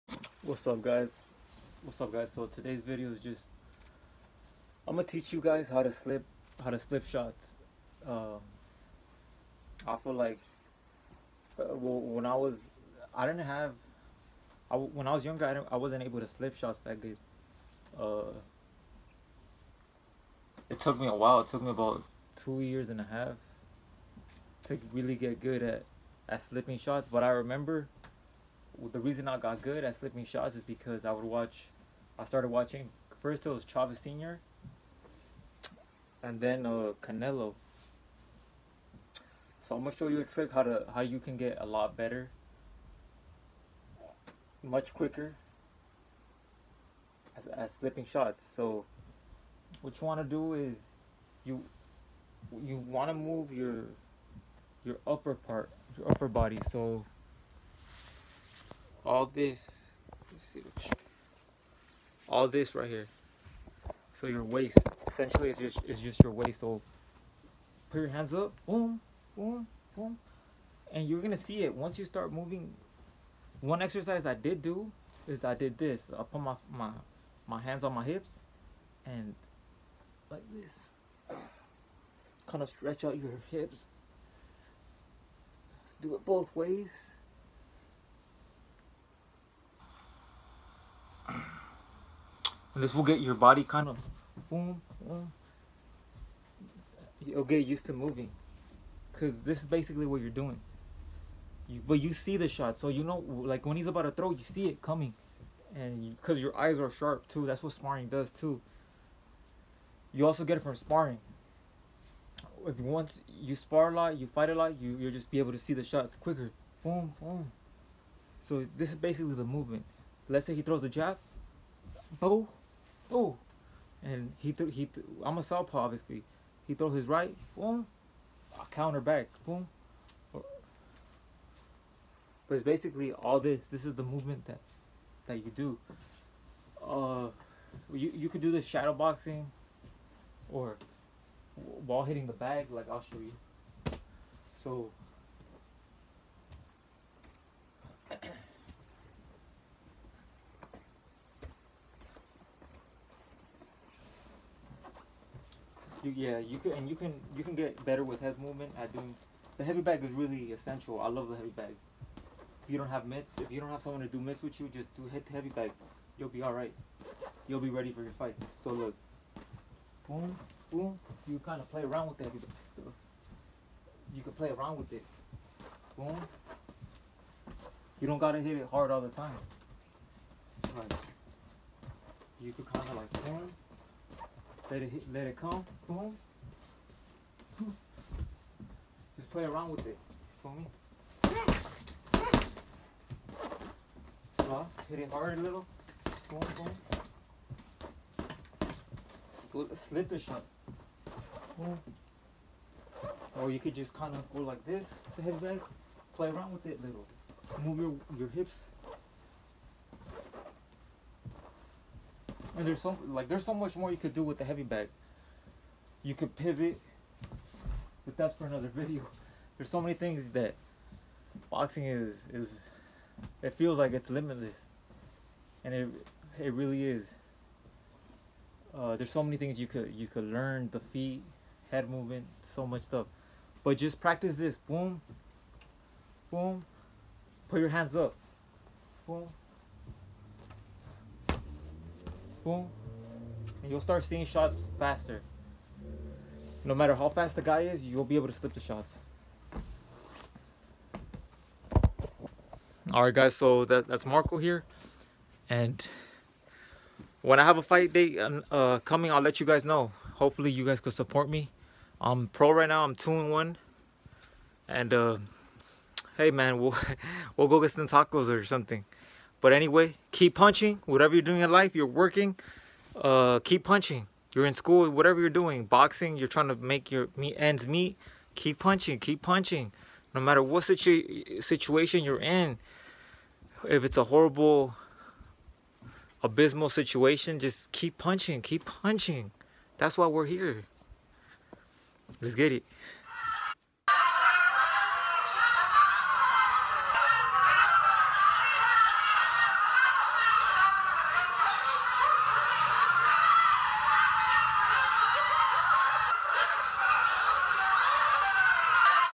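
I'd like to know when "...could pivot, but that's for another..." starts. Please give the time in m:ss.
3:36.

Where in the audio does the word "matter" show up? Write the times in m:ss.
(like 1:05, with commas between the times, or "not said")
4:06, 4:40.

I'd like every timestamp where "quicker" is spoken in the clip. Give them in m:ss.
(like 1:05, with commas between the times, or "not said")
0:44, 1:56.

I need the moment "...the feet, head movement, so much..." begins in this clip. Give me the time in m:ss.
3:50.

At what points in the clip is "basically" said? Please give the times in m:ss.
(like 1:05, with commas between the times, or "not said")
1:39, 1:58, 2:12.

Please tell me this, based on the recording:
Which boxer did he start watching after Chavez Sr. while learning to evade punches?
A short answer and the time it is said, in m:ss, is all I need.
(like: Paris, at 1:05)
Canelo, at 0:37.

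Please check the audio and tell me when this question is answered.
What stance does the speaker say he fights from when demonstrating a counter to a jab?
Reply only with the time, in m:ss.
2:05.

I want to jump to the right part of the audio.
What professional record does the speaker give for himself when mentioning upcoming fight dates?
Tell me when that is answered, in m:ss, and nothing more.
4:22.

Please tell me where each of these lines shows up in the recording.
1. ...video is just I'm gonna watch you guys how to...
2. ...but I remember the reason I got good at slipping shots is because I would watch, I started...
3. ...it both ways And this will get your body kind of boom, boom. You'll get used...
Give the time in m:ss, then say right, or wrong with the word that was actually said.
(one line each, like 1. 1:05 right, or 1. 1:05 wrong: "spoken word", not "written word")
1. 0:02 wrong: "teach", not "watch"
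2. 0:27 right
3. 1:26 right.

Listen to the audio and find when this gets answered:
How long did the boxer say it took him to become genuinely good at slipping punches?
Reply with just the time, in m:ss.
0:22.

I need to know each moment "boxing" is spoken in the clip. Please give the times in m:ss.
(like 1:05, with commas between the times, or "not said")
2:18, 3:41, 4:35.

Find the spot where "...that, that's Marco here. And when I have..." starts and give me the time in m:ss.
4:13.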